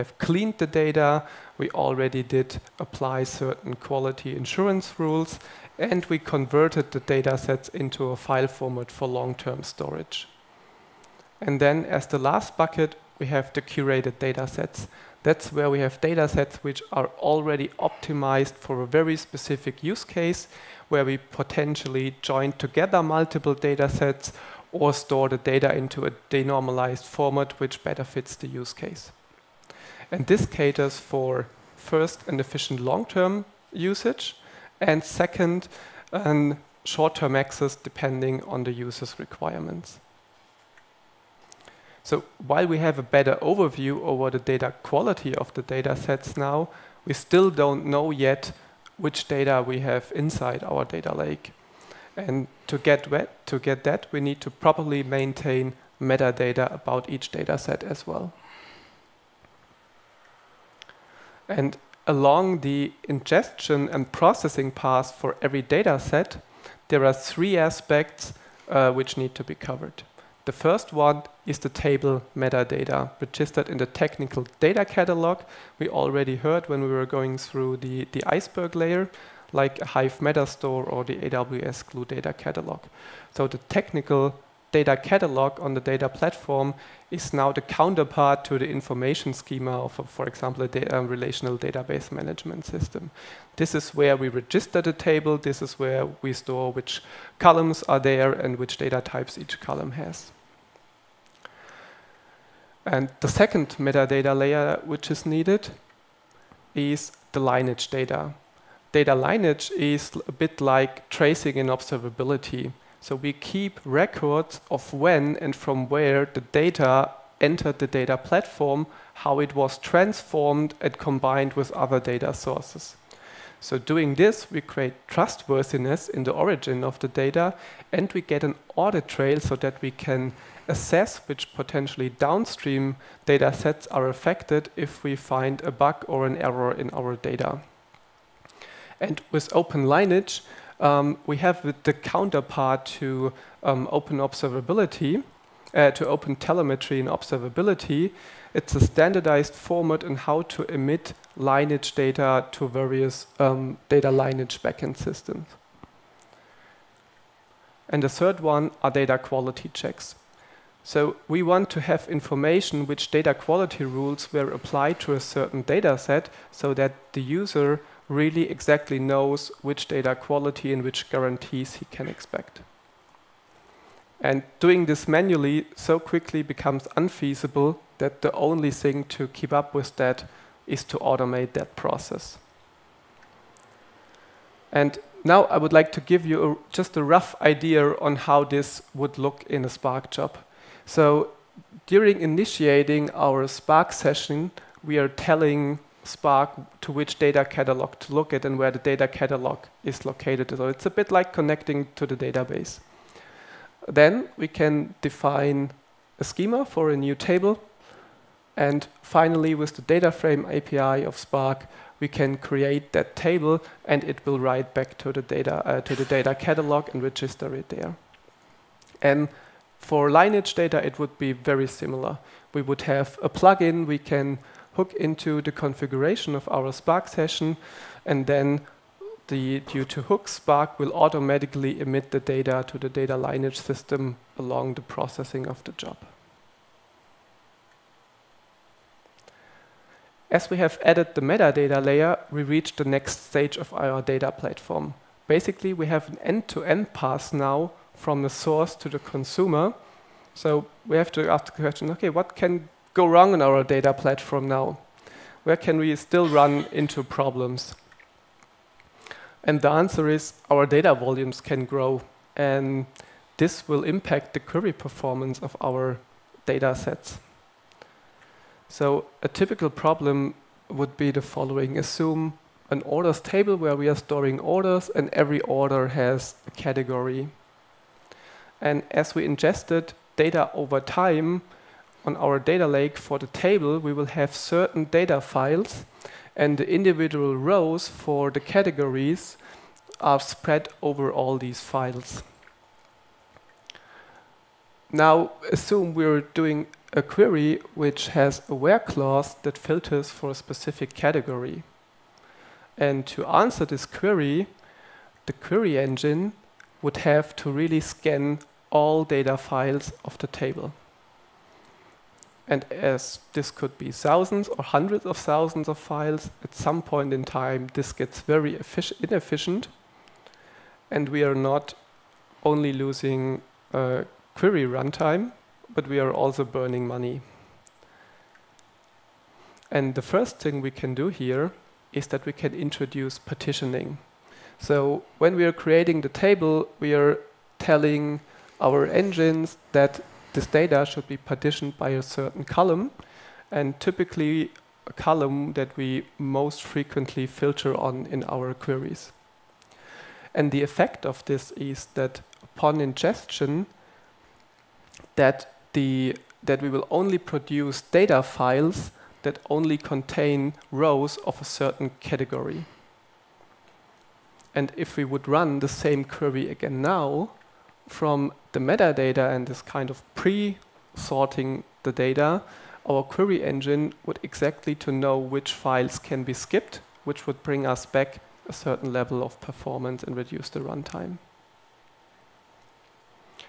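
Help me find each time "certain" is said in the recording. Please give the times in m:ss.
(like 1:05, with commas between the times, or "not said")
0:03, 2:45, 4:44, 5:42, 6:01, 6:18.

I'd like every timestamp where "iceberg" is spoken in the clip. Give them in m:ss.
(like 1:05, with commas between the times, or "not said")
1:18.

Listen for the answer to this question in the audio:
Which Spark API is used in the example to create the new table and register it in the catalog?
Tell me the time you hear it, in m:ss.
3:29.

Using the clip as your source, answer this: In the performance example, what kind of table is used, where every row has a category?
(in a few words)
orders table.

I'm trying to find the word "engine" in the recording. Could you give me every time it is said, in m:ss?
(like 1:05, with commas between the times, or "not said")
5:05, 5:38, 6:13.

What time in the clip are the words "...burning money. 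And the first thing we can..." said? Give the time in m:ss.
5:26.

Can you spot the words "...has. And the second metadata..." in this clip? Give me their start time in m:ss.
1:39.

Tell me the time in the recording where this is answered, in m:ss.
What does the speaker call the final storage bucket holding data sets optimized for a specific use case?
0:13.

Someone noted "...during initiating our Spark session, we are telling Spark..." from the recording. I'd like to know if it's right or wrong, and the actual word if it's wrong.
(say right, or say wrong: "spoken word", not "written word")
right.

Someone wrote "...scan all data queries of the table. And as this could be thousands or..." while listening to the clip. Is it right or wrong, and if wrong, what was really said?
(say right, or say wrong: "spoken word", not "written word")
wrong: "files", not "queries".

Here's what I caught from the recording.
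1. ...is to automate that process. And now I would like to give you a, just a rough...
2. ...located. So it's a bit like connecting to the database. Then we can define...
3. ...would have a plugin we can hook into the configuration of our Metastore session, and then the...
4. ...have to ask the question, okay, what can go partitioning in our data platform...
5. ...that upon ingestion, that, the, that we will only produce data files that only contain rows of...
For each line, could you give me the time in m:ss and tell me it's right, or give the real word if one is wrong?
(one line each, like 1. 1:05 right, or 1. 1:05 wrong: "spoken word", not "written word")
1. 3:00 right
2. 3:20 right
3. 3:42 wrong: "Spark", not "Metastore"
4. 4:10 wrong: "wrong", not "partitioning"
5. 5:51 right.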